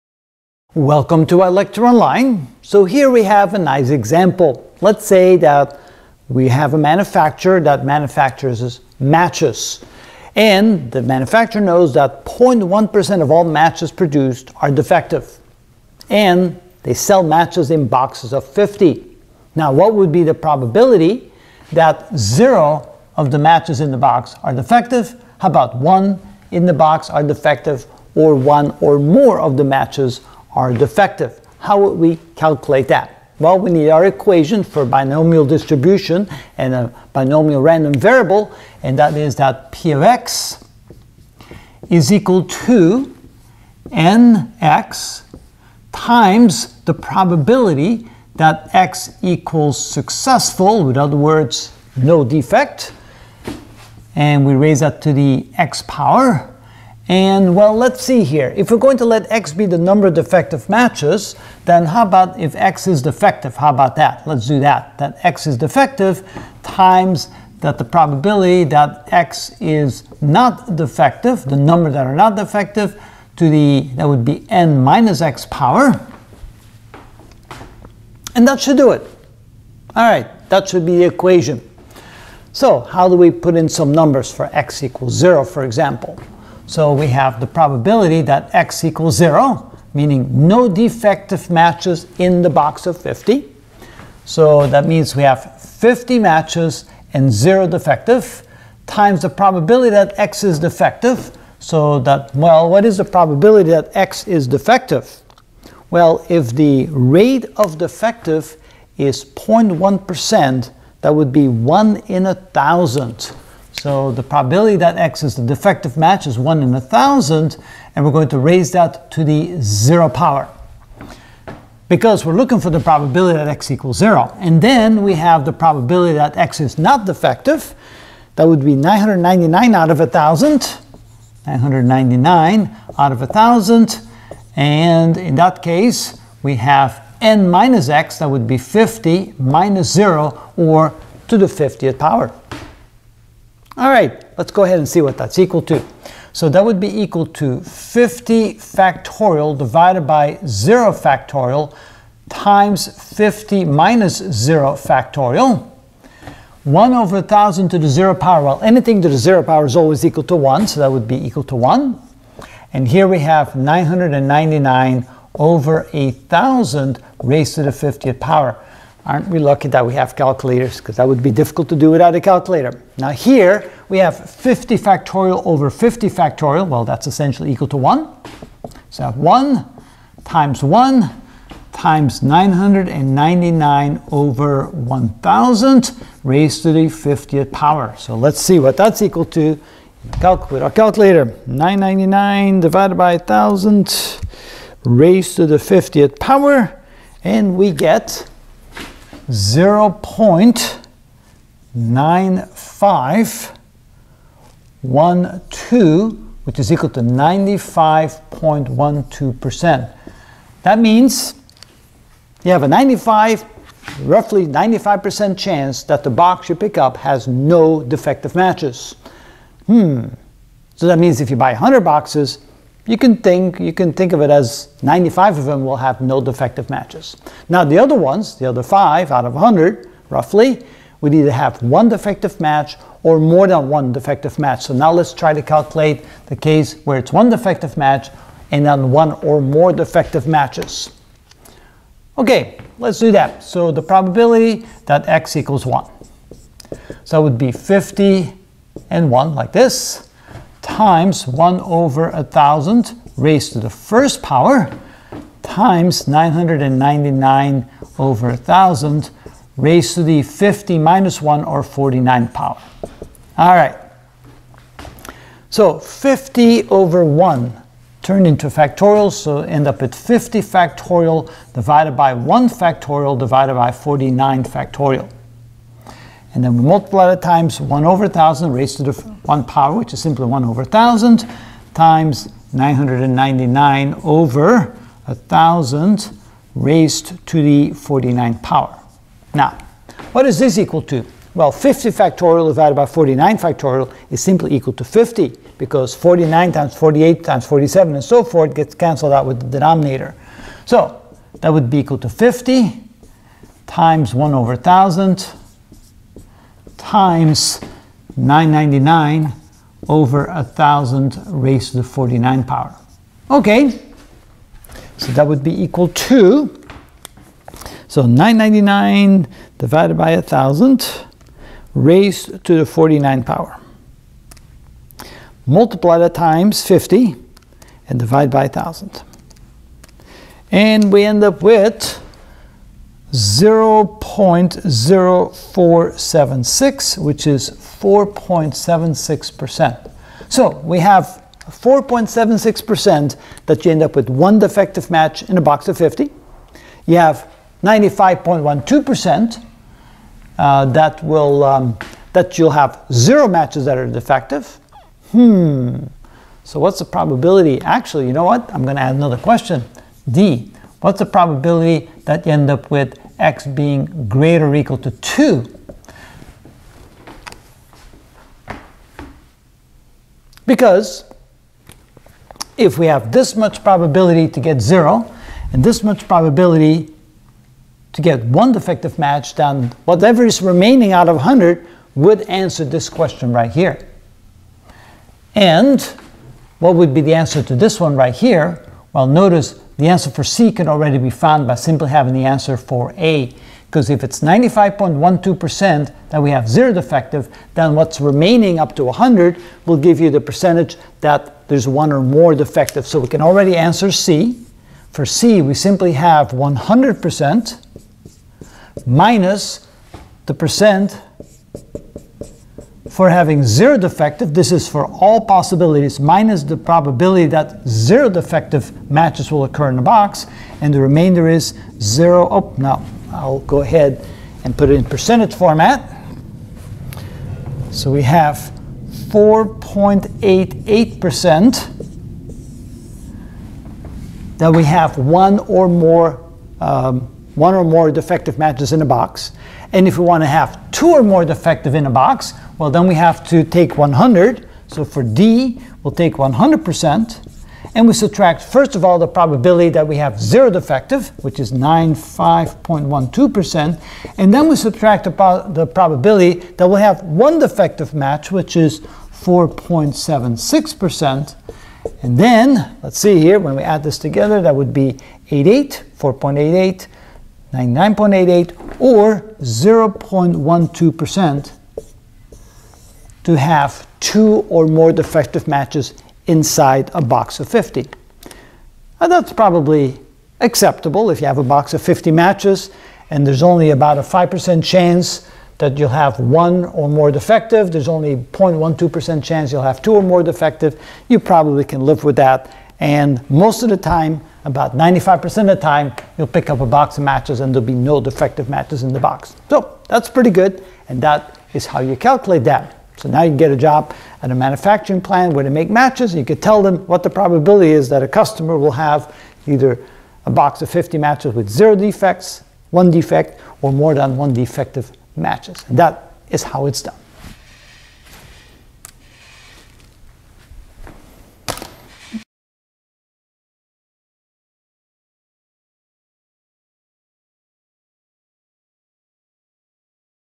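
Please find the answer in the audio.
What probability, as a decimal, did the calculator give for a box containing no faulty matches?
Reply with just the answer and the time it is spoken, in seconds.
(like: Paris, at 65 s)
0.9512, at 199 s.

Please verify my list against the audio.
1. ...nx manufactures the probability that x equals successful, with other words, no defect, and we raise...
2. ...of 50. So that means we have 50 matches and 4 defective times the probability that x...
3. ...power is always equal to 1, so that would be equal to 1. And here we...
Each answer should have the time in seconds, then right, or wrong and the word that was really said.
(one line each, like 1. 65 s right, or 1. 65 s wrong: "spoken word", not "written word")
1. 43 s wrong: "times", not "manufactures"
2. 92 s wrong: "0", not "4"
3. 159 s right.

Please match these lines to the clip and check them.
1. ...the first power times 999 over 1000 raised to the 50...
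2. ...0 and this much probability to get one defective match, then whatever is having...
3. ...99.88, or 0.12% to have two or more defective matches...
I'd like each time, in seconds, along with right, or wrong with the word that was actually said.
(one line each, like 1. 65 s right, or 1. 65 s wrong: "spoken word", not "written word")
1. 253 s right
2. 374 s wrong: "remaining", not "having"
3. 467 s right.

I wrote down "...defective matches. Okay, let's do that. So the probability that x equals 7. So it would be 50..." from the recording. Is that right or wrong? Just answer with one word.
wrong.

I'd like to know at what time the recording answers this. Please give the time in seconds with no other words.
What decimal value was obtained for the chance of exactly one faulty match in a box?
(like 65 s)
333 s.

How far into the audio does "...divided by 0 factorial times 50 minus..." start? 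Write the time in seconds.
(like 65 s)
149 s.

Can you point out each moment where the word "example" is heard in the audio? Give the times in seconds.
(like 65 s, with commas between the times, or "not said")
3 s, 85 s.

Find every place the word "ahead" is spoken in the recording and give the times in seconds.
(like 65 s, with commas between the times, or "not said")
144 s, 423 s.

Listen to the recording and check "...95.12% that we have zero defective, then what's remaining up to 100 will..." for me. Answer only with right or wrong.
right.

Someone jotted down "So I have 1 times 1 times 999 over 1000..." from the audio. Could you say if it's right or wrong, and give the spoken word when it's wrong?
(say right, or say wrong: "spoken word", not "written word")
right.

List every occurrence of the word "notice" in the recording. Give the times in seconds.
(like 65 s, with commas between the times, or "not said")
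389 s.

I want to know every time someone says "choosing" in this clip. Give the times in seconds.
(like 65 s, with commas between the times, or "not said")
not said.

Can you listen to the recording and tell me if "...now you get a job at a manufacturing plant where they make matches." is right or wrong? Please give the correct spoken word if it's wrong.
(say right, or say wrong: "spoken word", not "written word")
right.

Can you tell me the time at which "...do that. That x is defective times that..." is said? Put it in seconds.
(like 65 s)
64 s.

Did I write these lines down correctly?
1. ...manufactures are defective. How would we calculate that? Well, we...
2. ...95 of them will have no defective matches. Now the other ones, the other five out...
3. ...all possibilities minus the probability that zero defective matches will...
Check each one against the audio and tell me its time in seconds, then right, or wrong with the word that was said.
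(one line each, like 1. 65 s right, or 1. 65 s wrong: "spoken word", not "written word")
1. 29 s wrong: "matches", not "manufactures"
2. 224 s right
3. 414 s right.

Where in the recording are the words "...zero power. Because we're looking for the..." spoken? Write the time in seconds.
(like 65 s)
119 s.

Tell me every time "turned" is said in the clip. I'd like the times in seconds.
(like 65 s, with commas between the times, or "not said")
268 s.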